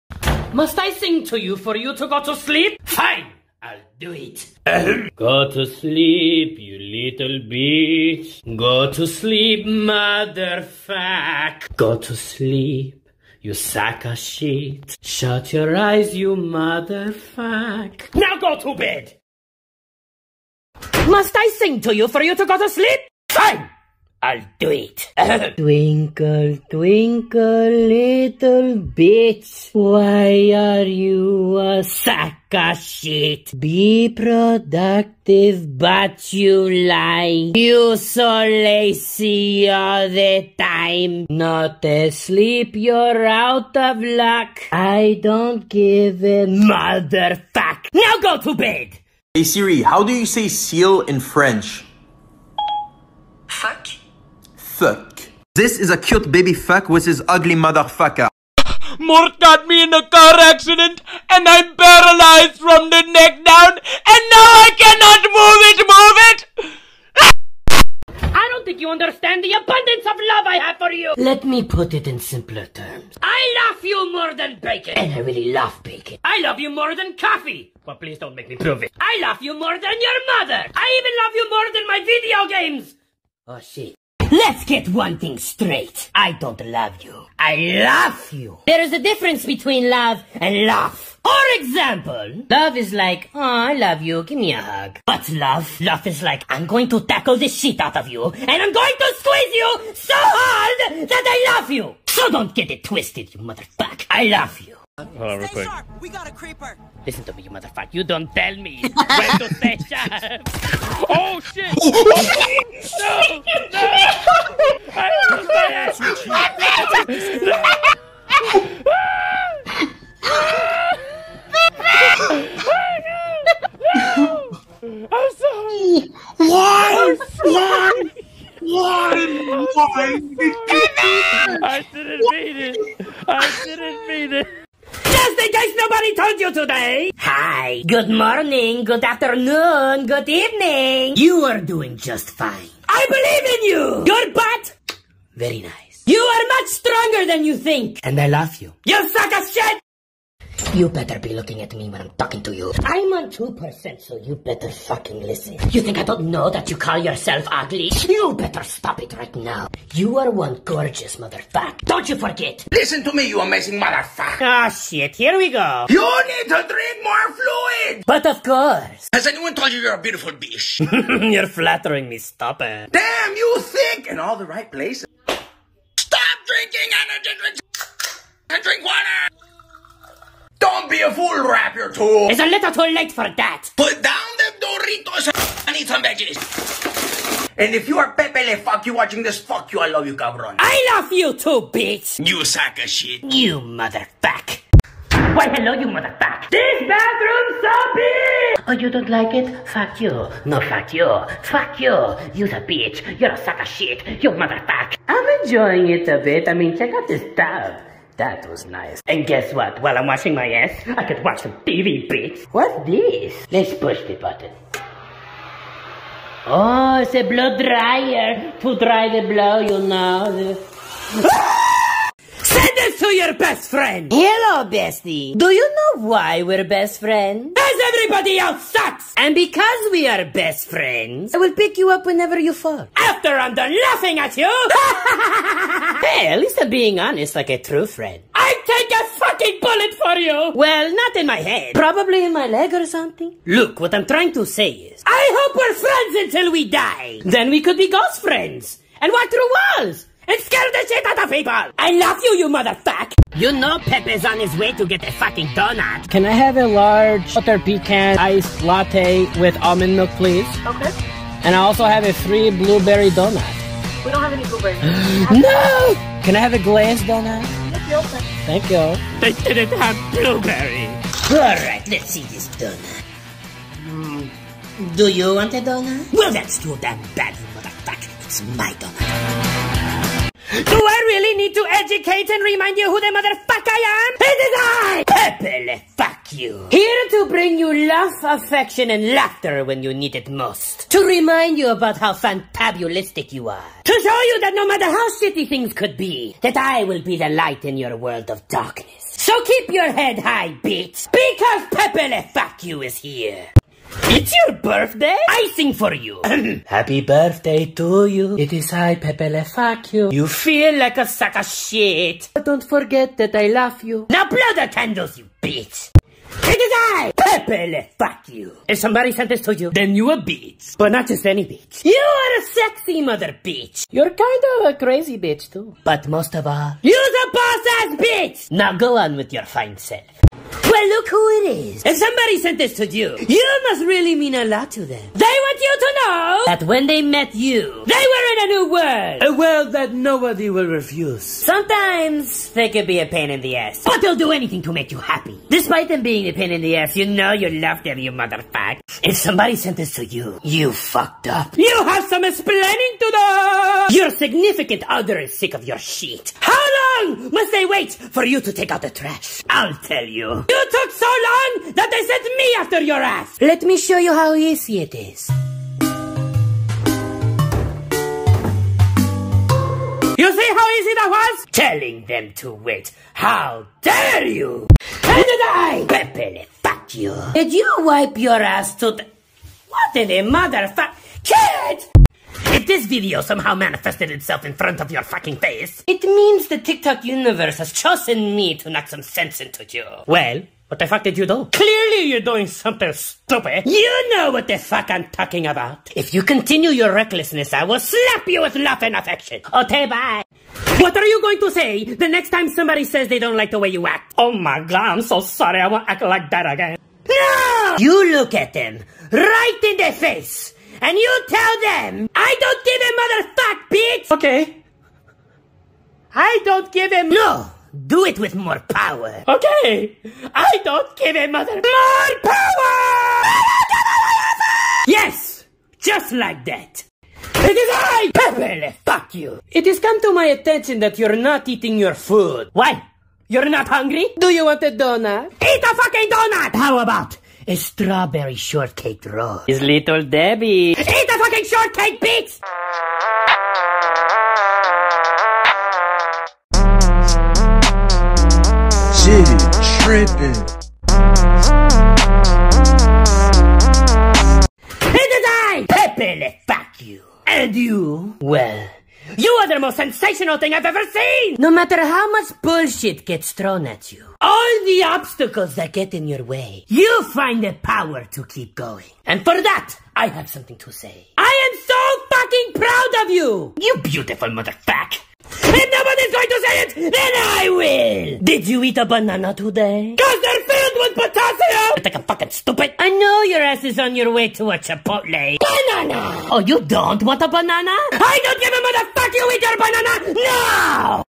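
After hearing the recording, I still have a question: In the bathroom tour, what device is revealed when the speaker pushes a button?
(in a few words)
Blow dryer.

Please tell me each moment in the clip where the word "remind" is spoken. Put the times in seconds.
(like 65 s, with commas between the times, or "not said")
282 s, 291 s.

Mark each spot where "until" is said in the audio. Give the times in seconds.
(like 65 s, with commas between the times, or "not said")
246 s.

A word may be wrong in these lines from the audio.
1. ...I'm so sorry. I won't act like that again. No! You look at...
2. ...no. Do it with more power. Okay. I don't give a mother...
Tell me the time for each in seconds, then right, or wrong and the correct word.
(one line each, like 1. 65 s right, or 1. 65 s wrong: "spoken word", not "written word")
1. 404 s right
2. 417 s right.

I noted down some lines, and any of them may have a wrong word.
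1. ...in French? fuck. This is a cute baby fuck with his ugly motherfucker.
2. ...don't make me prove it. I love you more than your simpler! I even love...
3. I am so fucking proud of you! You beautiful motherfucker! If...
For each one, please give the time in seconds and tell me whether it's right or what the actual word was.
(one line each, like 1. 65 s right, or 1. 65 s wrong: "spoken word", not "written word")
1. 51 s right
2. 78 s wrong: "mother", not "simpler"
3. 471 s right.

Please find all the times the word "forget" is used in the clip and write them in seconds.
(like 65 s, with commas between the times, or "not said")
162 s, 312 s.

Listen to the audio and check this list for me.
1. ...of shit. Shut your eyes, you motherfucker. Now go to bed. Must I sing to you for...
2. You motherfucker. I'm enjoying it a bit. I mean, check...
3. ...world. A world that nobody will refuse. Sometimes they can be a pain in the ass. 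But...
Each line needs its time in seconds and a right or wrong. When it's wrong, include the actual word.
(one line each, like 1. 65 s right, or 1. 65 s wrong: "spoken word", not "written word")
1. 14 s right
2. 204 s right
3. 338 s right.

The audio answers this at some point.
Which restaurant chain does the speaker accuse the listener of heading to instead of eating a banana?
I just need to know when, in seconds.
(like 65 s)
484 s.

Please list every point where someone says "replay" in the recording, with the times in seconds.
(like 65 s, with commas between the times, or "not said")
not said.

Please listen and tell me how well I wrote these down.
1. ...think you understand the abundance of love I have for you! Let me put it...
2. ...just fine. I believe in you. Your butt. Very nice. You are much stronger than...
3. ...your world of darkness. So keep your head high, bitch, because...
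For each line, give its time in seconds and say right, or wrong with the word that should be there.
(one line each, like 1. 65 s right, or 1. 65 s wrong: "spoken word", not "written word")
1. 68 s right
2. 141 s right
3. 297 s right.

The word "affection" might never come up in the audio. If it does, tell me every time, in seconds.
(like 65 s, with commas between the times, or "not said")
288 s, 398 s.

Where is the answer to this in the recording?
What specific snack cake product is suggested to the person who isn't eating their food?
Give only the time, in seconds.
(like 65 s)
437 s.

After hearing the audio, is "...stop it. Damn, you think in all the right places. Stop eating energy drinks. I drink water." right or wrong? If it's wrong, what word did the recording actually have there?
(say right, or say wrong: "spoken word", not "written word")
wrong: "drinking", not "eating".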